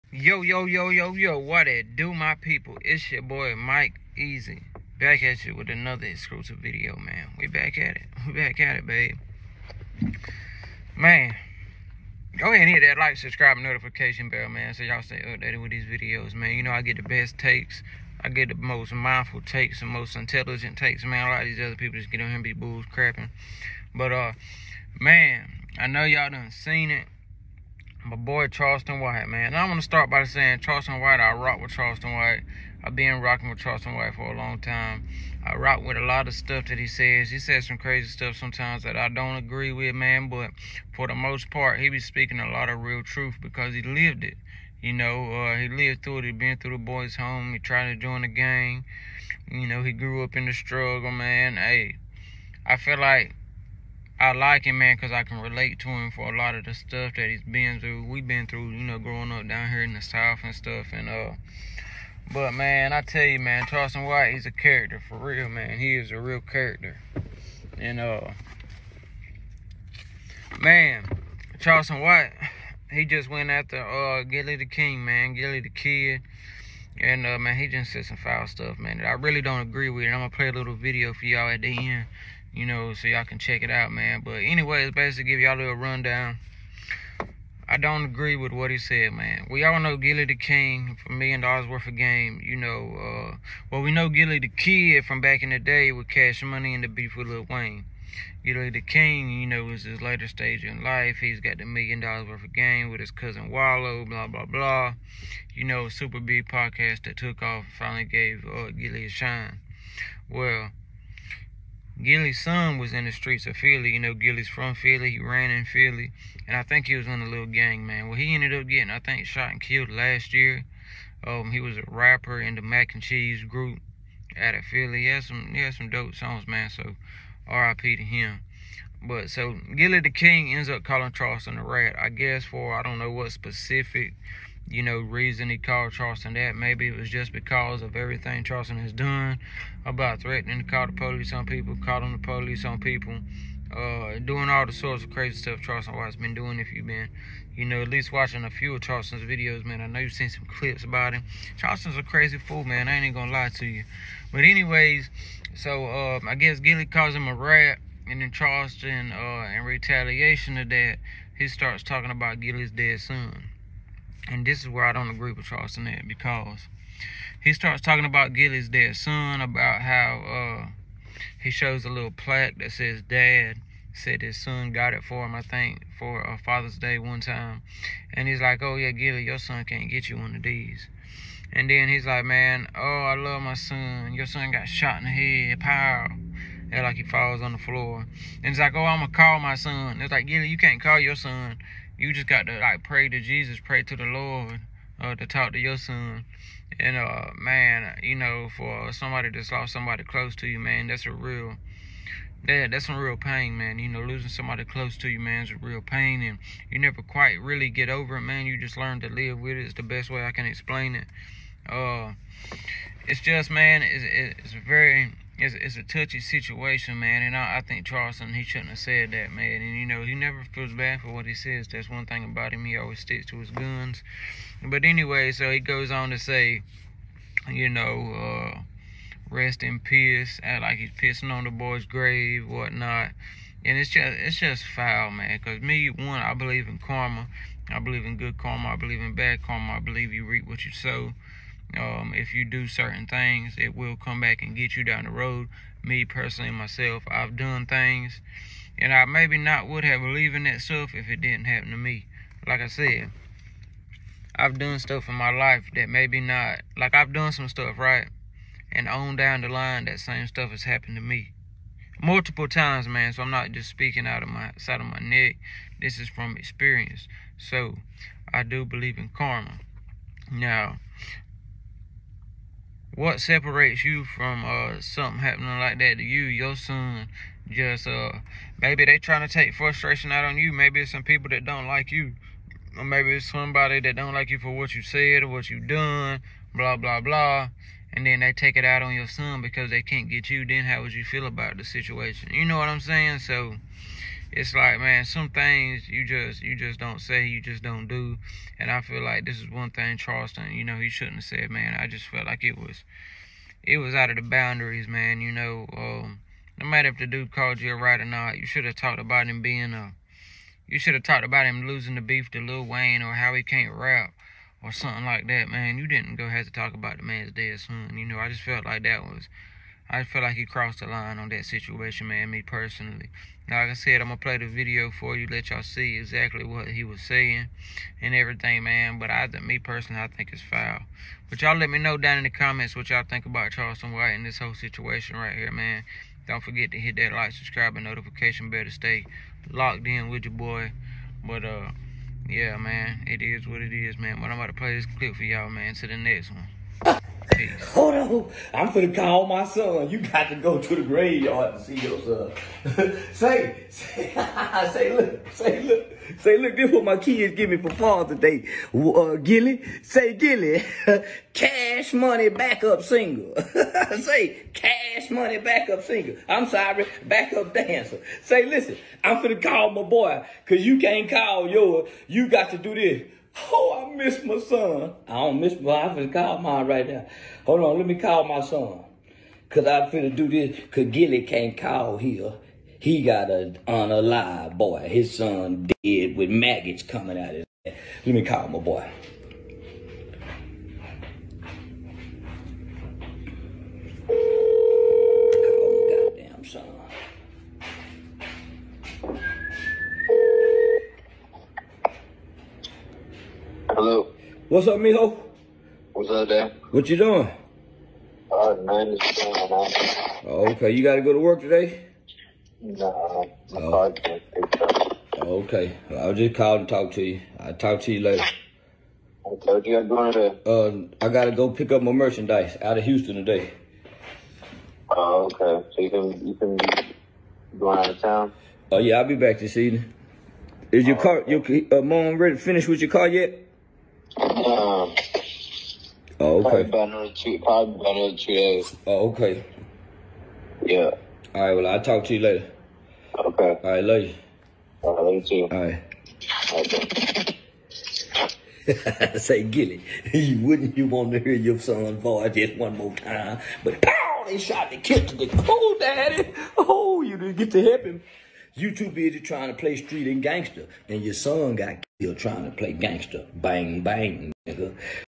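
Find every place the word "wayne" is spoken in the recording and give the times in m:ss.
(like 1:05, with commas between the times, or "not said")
1:37, 5:12.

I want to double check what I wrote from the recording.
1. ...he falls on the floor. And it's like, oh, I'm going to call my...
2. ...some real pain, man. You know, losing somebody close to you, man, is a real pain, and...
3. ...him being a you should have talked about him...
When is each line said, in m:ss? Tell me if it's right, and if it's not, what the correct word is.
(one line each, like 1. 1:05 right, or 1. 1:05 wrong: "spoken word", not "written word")
1. 3:06 right
2. 3:22 right
3. 5:09 right.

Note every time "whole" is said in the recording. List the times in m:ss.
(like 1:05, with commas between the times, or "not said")
5:34.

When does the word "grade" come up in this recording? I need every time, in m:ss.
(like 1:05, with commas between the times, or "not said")
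not said.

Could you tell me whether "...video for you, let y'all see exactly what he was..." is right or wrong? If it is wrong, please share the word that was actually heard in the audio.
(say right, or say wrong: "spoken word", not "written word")
right.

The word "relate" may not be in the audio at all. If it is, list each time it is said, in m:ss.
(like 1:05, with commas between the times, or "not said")
0:55.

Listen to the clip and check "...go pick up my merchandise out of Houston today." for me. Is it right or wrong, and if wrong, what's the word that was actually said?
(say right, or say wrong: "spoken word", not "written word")
right.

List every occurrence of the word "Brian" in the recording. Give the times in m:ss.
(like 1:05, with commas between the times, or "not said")
not said.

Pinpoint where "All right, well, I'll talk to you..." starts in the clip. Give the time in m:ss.
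7:21.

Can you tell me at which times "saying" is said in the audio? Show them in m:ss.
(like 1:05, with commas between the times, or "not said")
0:30, 4:52, 5:27.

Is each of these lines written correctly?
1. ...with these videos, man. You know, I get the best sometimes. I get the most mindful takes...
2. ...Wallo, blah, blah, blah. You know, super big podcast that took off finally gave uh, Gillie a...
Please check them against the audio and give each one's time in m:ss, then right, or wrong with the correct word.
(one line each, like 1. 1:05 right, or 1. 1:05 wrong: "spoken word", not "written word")
1. 0:15 wrong: "takes", not "sometimes"
2. 1:43 right.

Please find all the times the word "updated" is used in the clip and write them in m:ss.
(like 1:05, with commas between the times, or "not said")
0:15.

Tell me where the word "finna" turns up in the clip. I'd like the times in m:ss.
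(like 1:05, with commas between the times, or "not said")
5:48, 6:09, 6:15, 6:19.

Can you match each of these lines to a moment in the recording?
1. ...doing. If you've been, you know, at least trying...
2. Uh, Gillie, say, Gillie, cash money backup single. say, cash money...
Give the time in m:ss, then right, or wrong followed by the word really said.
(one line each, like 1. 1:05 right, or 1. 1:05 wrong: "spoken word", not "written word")
1. 2:26 wrong: "watching", not "trying"
2. 5:58 right.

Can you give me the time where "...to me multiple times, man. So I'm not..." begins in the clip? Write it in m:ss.
4:20.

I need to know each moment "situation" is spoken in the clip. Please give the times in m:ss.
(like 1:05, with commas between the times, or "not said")
3:36, 4:51, 5:21, 5:34.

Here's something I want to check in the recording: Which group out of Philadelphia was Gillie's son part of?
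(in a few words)
Mac and Cheese.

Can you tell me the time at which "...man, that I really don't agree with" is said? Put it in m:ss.
1:18.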